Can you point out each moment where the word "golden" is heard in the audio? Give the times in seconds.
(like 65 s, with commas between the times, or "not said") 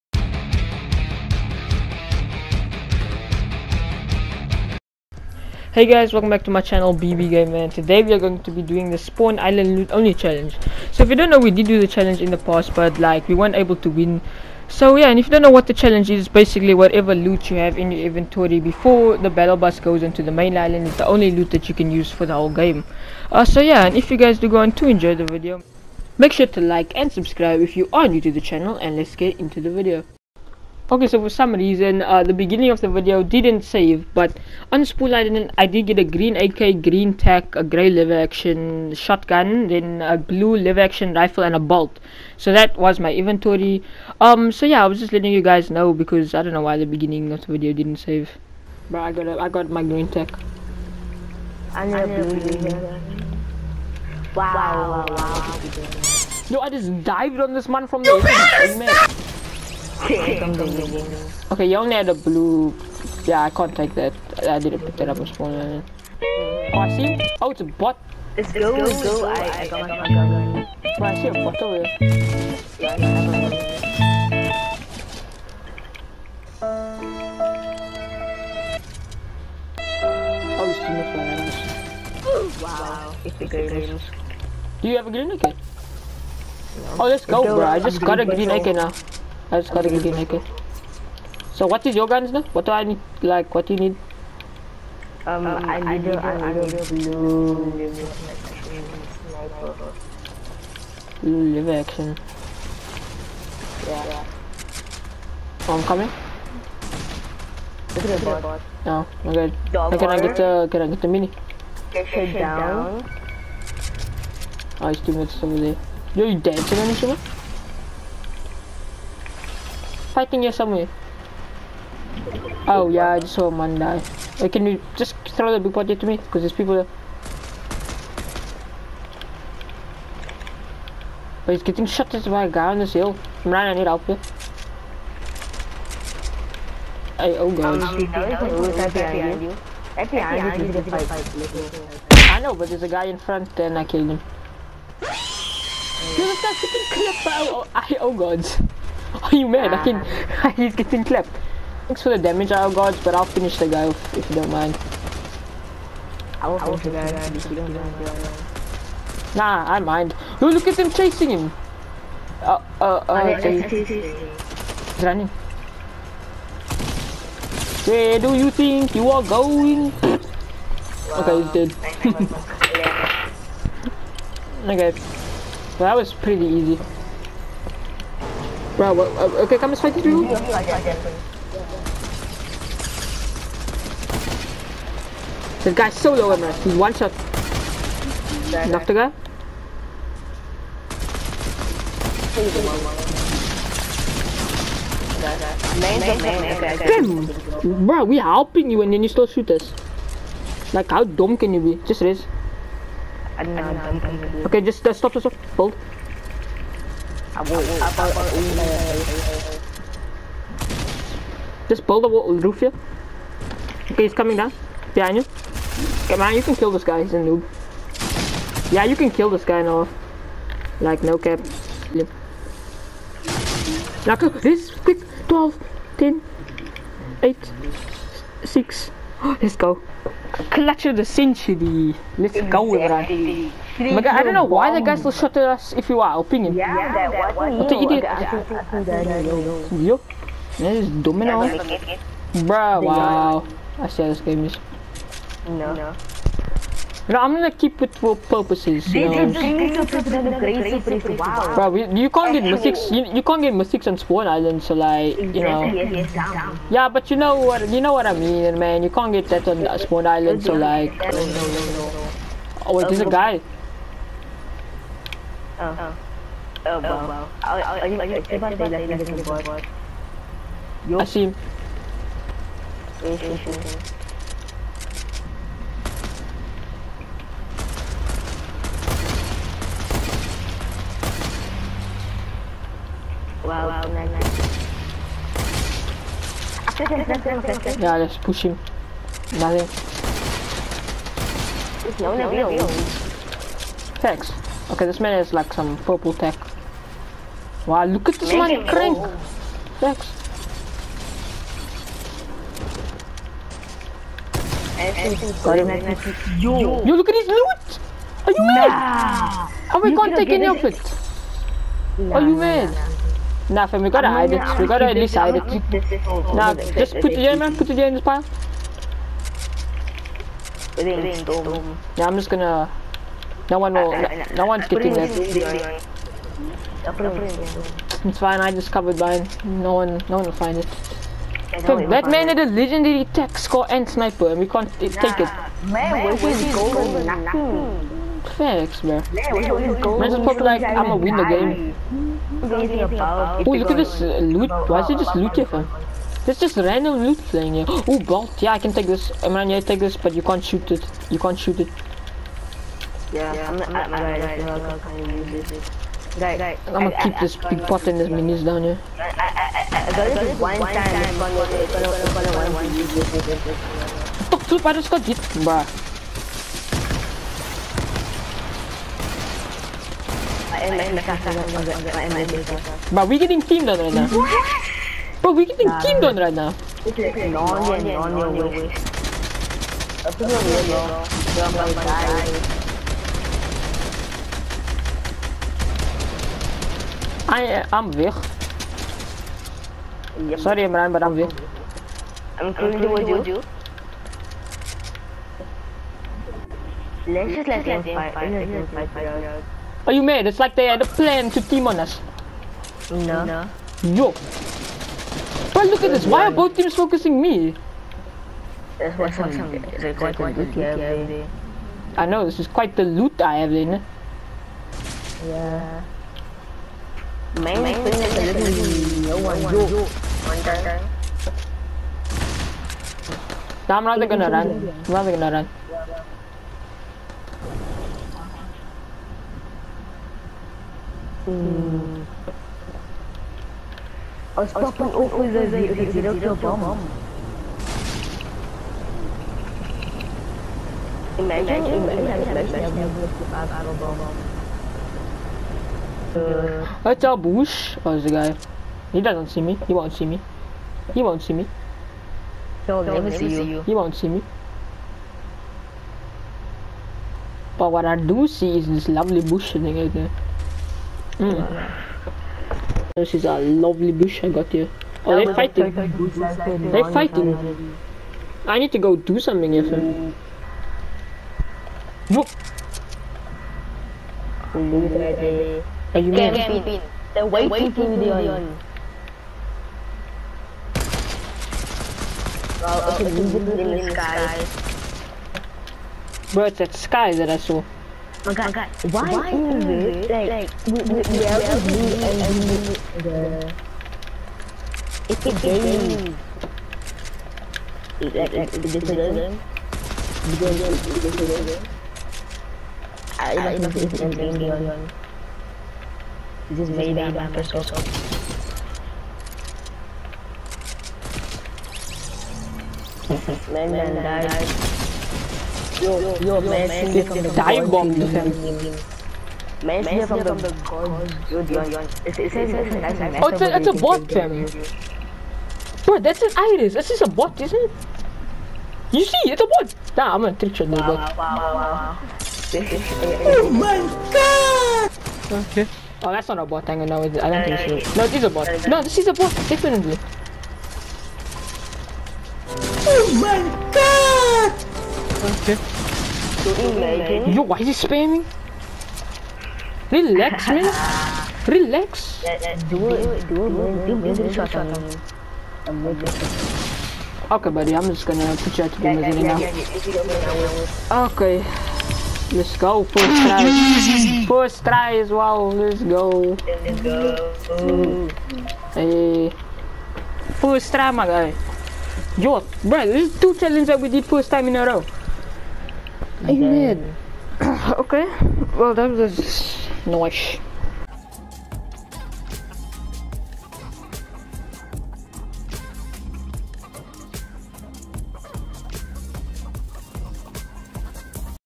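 336 s.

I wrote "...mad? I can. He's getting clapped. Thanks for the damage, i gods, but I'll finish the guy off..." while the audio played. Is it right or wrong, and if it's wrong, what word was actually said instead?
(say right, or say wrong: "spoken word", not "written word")
right.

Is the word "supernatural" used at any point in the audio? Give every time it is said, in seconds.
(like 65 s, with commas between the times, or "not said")
not said.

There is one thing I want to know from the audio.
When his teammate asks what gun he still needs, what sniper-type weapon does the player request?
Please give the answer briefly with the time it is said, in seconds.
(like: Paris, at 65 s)
blue sniper, at 96 s.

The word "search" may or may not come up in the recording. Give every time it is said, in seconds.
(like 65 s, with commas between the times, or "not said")
not said.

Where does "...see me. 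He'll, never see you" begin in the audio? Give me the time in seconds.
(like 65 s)
451 s.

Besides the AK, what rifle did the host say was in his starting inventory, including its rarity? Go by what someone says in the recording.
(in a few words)
blue lever action rifle.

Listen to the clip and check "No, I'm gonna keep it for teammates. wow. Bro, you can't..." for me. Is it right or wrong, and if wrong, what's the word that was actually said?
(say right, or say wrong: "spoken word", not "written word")
wrong: "purposes", not "teammates".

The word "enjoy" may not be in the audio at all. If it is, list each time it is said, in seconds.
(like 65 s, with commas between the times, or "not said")
24 s.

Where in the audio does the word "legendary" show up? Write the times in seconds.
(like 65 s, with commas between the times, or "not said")
332 s.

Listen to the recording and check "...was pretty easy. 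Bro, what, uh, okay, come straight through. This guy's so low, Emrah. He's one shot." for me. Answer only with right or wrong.
right.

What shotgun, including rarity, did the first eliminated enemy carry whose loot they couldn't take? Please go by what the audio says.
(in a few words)
purple tac.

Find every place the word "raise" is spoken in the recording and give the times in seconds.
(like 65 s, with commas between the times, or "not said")
202 s.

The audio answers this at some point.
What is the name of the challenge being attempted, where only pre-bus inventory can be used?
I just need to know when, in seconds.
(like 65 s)
8 s.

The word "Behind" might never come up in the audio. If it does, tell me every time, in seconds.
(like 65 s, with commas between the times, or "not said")
214 s.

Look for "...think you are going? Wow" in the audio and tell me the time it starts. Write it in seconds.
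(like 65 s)
168 s.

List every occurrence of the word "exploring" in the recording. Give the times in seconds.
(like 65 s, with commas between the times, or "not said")
not said.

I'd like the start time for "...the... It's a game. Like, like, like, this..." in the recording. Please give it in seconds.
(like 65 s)
493 s.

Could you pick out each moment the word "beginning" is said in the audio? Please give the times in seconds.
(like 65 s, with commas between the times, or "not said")
32 s, 46 s.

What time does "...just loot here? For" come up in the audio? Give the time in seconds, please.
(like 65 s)
344 s.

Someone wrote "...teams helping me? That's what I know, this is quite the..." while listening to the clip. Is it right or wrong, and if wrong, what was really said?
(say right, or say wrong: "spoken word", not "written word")
wrong: "focusing", not "helping".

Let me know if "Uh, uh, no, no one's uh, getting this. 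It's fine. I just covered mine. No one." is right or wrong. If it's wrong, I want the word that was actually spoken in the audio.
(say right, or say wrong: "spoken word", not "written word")
right.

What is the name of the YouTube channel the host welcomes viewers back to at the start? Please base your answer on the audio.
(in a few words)
BB Game Man.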